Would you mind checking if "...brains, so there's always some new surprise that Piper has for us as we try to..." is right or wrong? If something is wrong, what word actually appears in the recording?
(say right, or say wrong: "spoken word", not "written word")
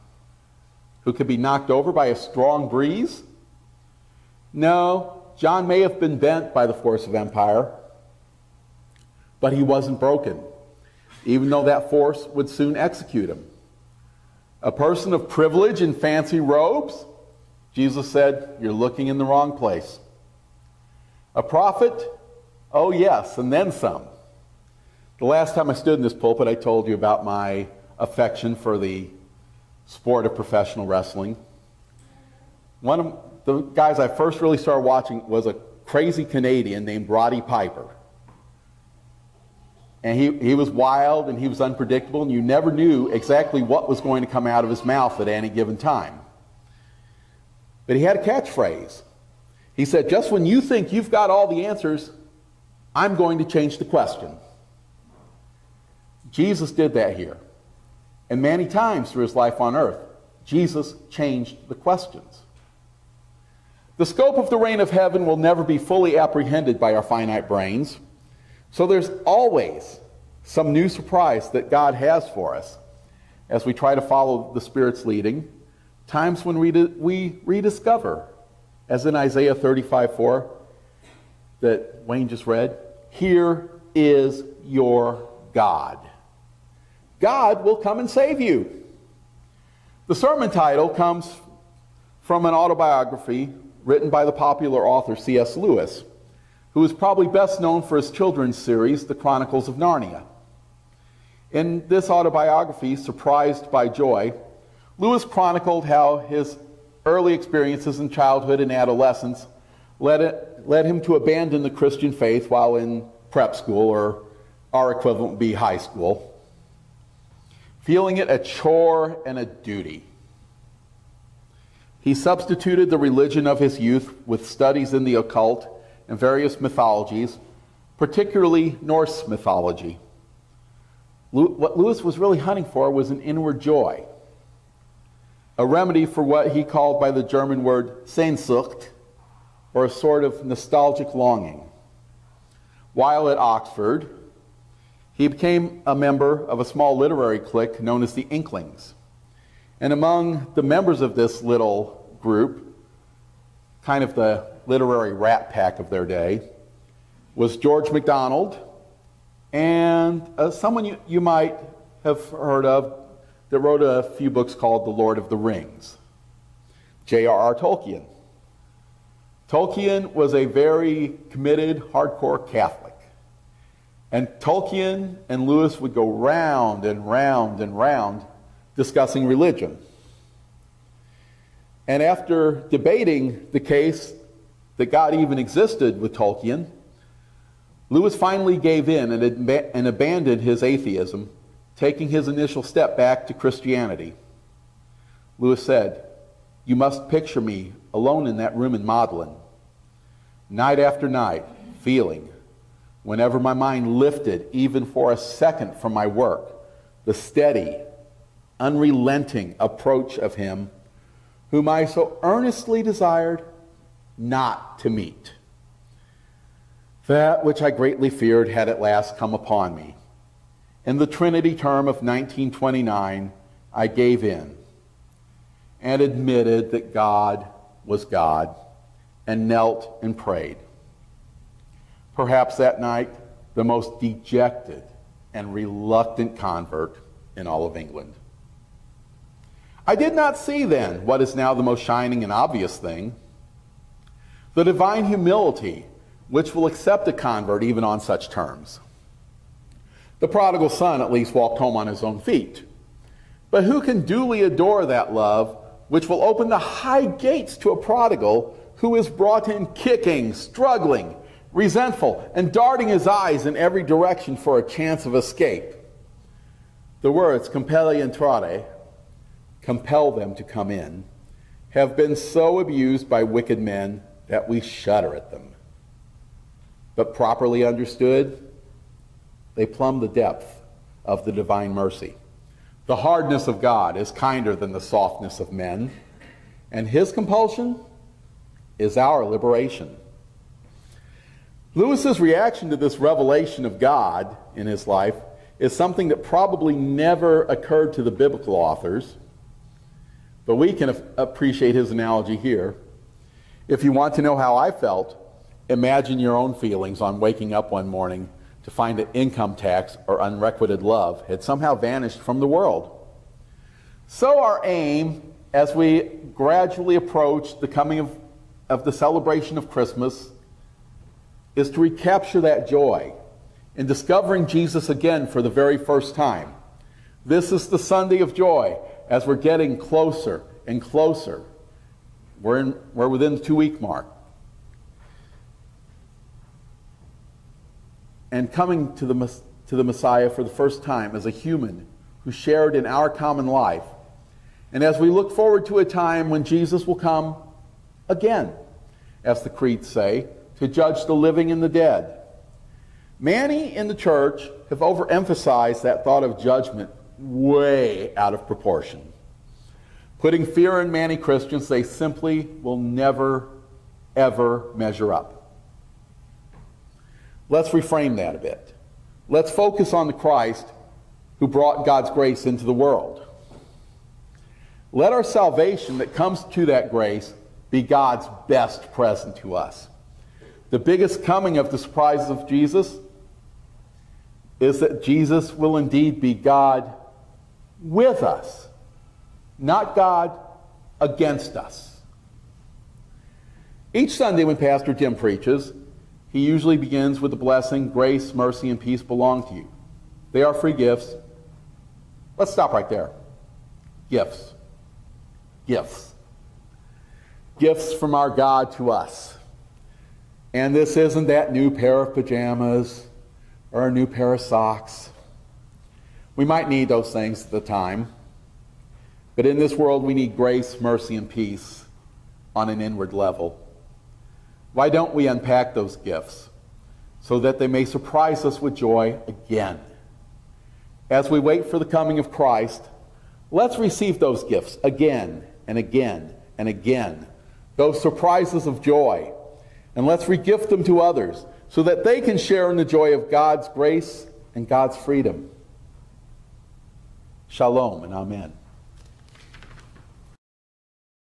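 wrong: "God", not "Piper".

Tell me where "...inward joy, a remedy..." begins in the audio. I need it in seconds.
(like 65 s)
133 s.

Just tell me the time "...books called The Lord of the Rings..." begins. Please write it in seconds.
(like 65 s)
164 s.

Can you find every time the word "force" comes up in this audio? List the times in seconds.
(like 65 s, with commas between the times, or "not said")
6 s, 11 s.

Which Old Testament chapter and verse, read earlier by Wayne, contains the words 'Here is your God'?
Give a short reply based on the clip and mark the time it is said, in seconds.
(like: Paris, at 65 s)
Isaiah 35:4, at 79 s.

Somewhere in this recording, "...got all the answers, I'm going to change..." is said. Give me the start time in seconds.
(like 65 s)
51 s.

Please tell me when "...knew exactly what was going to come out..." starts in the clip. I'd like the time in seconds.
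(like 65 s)
42 s.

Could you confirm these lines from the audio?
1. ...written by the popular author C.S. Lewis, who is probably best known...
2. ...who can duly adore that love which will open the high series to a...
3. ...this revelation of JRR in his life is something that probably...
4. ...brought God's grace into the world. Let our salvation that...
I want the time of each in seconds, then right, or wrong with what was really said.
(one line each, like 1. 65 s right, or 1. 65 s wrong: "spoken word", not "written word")
1. 93 s right
2. 253 s wrong: "gates", not "series"
3. 292 s wrong: "God", not "JRR"
4. 371 s right.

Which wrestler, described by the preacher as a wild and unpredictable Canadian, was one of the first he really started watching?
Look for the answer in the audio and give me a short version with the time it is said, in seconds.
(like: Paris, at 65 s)
Roddy Piper, at 37 s.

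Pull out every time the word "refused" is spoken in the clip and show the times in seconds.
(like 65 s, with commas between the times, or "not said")
not said.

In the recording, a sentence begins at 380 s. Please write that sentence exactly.
The biggest coming of the surprises of Jesus is that Jesus will indeed be God with us, not God against us.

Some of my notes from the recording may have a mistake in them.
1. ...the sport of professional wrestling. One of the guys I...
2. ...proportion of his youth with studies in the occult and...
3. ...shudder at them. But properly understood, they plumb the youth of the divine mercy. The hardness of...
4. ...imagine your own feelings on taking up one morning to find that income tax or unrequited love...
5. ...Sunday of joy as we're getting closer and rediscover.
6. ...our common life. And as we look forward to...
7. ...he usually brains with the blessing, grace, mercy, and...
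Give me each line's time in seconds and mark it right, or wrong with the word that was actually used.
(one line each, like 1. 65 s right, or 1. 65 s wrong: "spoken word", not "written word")
1. 28 s right
2. 122 s wrong: "religion", not "proportion"
3. 274 s wrong: "depth", not "youth"
4. 305 s wrong: "waking", not "taking"
5. 327 s wrong: "closer", not "rediscover"
6. 342 s right
7. 396 s wrong: "begins", not "brains".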